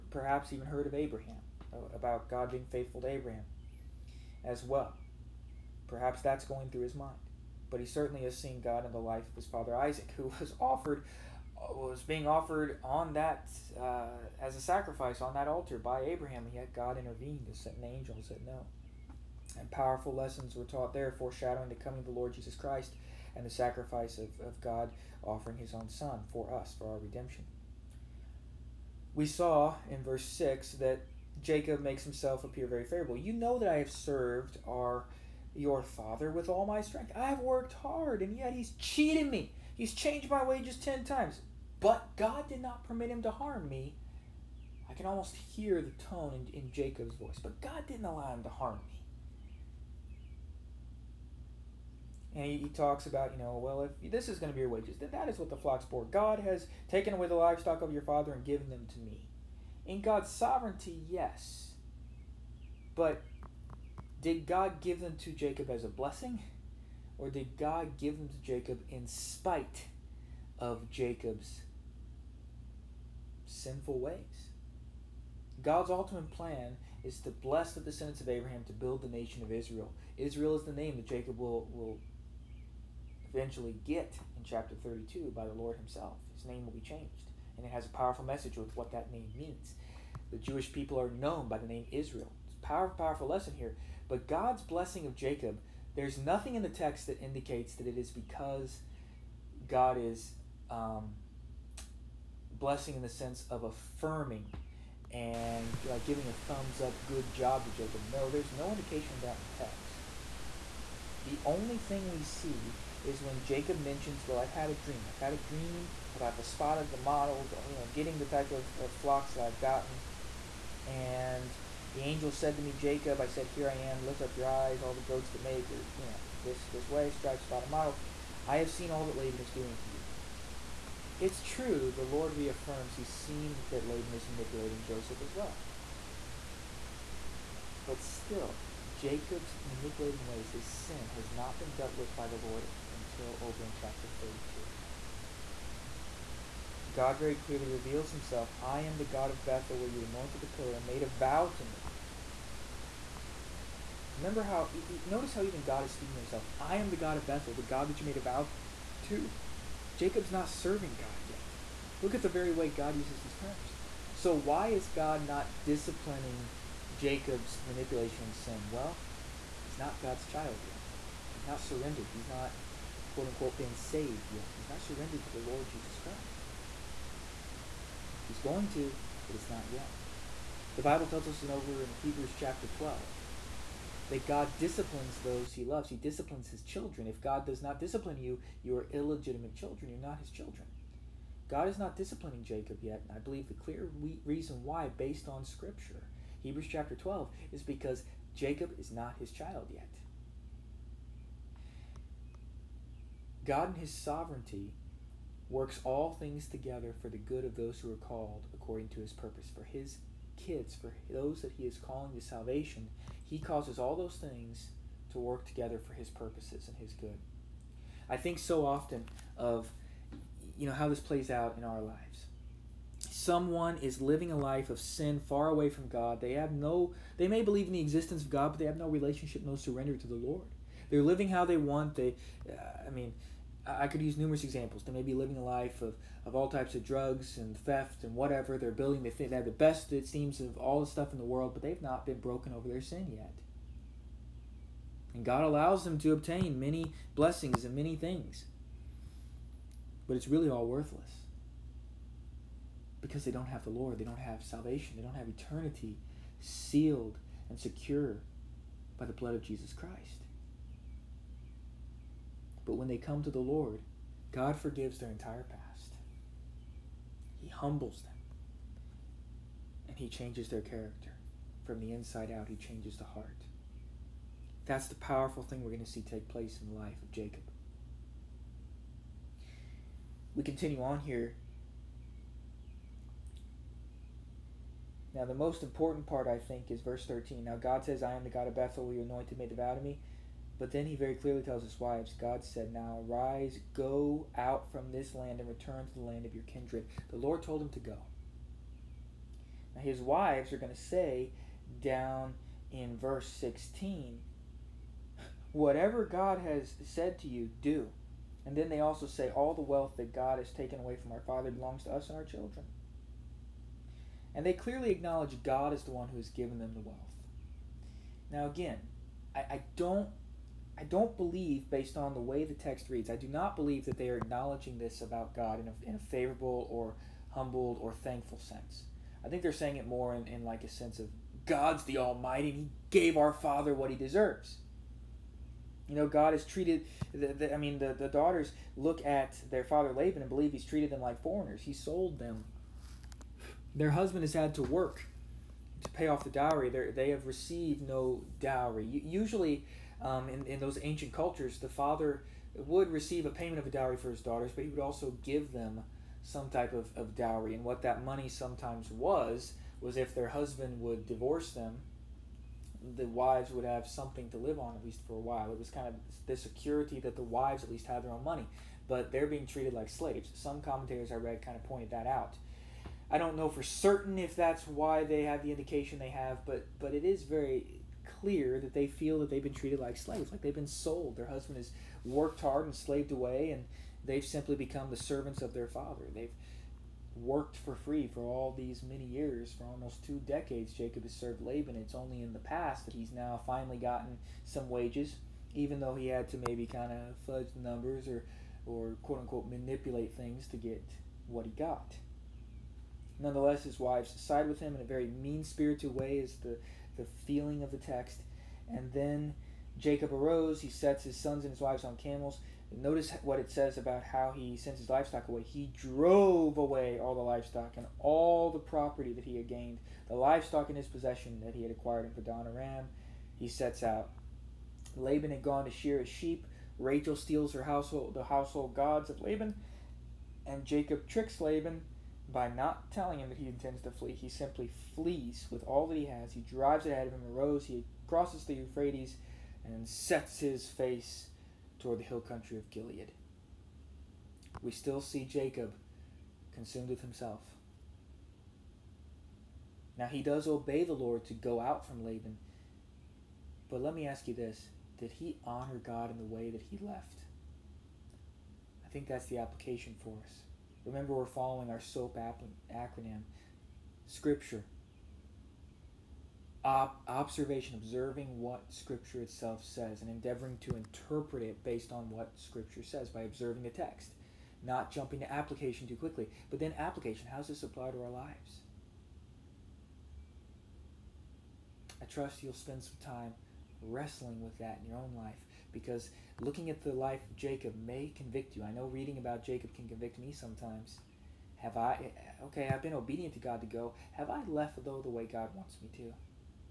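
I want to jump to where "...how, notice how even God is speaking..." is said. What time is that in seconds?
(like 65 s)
154 s.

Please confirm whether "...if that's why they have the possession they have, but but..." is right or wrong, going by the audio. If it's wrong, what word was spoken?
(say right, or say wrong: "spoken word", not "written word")
wrong: "indication", not "possession".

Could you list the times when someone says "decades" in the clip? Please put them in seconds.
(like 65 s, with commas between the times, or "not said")
390 s.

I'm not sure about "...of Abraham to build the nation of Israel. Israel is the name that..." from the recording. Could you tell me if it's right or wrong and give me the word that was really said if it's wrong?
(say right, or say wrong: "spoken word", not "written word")
right.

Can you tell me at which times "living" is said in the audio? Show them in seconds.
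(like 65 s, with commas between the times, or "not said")
223 s, 231 s, 235 s.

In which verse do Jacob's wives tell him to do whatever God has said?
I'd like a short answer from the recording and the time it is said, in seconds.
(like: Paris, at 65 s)
Verse 16, at 302 s.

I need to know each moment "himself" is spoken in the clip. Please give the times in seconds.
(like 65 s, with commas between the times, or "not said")
32 s, 85 s, 148 s, 156 s, 447 s.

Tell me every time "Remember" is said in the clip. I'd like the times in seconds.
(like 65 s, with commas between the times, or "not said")
154 s, 460 s.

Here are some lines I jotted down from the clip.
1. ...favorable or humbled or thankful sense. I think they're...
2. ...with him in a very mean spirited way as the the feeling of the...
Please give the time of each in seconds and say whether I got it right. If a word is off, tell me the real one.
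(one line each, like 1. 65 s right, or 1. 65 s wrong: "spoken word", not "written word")
1. 325 s right
2. 404 s right.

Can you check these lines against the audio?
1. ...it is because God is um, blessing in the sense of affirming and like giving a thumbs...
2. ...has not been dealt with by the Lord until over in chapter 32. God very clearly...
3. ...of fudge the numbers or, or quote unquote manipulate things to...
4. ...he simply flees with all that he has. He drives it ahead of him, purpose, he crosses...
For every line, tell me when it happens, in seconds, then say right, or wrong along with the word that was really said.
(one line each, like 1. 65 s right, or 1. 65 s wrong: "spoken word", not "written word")
1. 97 s right
2. 141 s right
3. 396 s right
4. 434 s wrong: "arose", not "purpose".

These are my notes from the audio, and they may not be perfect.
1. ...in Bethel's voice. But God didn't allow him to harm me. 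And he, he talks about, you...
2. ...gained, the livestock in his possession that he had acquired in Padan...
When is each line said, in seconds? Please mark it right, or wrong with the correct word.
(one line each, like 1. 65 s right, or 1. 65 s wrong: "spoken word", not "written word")
1. 46 s wrong: "Jacob", not "Bethel"
2. 419 s right.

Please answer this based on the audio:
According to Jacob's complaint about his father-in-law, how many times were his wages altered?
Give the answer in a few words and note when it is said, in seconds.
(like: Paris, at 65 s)
10, at 40 s.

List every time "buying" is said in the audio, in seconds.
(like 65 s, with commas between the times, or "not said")
not said.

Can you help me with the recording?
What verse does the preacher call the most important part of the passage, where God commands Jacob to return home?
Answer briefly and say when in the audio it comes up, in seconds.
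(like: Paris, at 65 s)
Verse 13, at 286 s.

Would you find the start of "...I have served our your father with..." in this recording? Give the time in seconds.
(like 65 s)
33 s.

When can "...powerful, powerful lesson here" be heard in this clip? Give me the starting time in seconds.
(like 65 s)
92 s.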